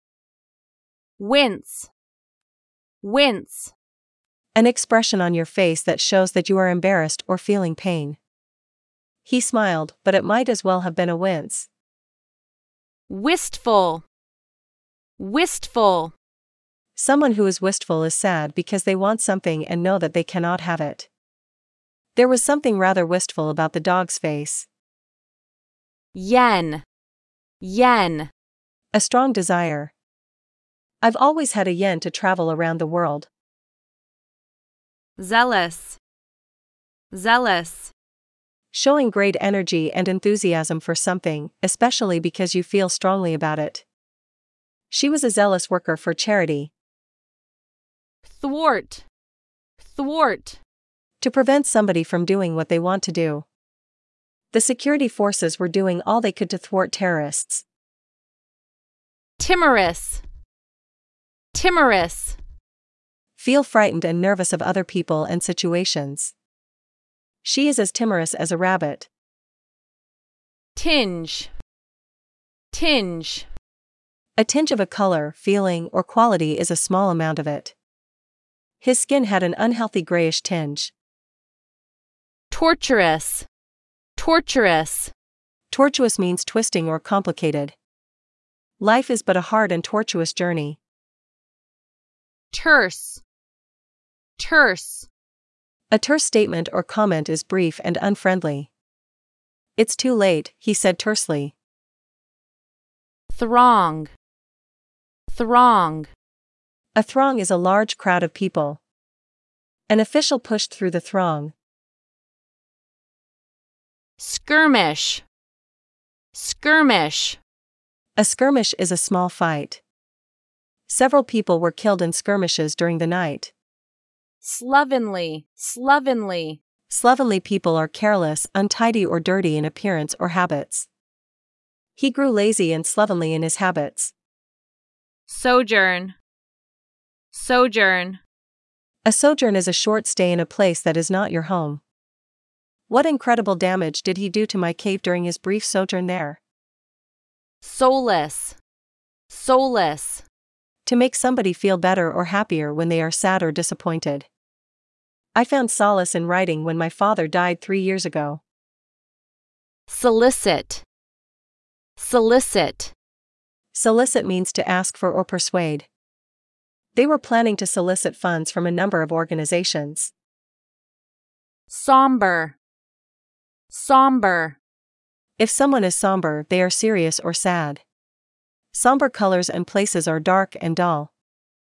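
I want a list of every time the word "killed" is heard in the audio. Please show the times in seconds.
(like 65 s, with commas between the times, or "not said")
121 s.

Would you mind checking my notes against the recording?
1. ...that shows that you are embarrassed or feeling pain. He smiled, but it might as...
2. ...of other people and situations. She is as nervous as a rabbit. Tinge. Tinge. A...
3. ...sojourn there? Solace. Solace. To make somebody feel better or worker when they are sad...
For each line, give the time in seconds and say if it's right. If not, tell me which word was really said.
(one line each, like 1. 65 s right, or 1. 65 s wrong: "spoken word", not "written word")
1. 5 s right
2. 64 s wrong: "timorous", not "nervous"
3. 145 s wrong: "happier", not "worker".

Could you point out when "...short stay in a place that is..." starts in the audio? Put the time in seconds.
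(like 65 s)
139 s.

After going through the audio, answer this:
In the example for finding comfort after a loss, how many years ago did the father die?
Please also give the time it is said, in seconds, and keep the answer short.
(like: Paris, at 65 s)
3, at 157 s.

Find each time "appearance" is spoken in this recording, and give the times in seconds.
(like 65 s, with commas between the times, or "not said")
129 s.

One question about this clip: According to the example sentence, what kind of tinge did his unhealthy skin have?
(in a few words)
grayish.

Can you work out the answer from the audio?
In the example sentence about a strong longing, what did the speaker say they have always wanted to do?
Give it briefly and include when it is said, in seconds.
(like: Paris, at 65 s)
travel around the world, at 32 s.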